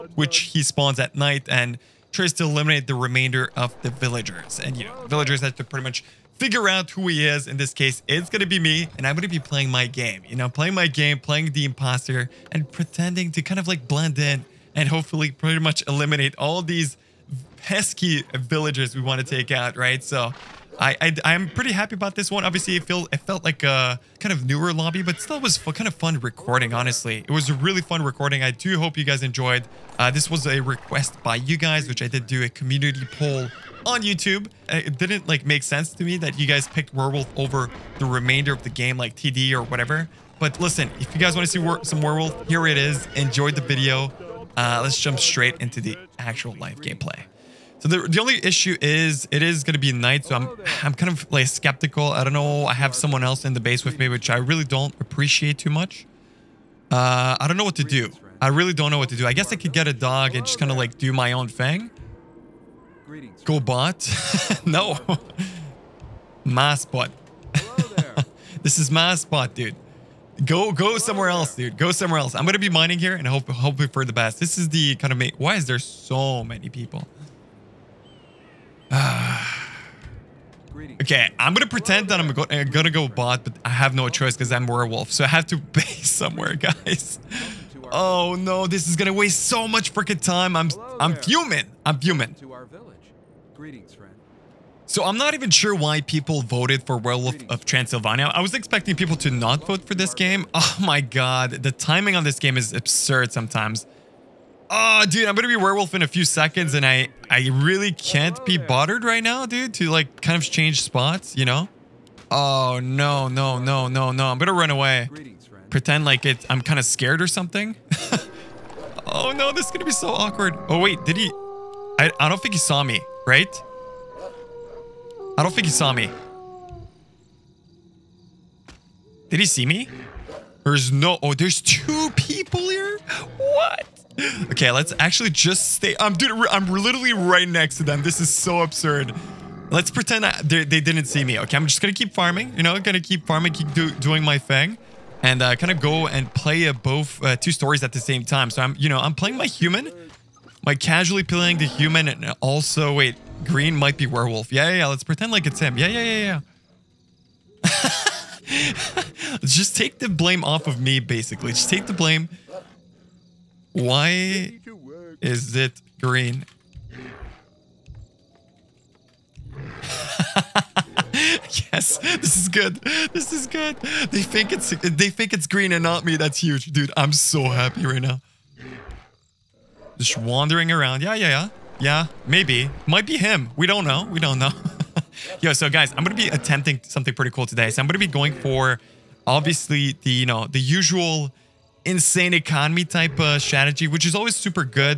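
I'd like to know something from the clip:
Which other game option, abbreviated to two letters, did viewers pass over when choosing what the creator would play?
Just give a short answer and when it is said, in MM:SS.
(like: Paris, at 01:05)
TD, at 00:39.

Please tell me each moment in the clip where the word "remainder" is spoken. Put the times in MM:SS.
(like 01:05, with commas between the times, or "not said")
00:02, 00:38.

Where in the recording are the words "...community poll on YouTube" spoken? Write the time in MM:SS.
00:32.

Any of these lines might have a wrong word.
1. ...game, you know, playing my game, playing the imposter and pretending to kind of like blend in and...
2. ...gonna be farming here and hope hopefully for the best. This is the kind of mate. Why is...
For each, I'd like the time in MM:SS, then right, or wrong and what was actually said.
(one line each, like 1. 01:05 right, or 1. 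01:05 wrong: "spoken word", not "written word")
1. 00:09 right
2. 01:12 wrong: "mining", not "farming".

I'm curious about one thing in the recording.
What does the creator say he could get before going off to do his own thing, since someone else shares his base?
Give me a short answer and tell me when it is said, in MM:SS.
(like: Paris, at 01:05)
a dog, at 00:59.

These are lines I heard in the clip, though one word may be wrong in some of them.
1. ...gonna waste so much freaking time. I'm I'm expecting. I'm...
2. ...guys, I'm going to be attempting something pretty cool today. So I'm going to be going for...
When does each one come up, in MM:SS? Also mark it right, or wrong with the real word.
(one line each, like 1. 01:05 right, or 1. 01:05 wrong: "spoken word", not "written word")
1. 01:28 wrong: "fuming", not "expecting"
2. 03:05 right.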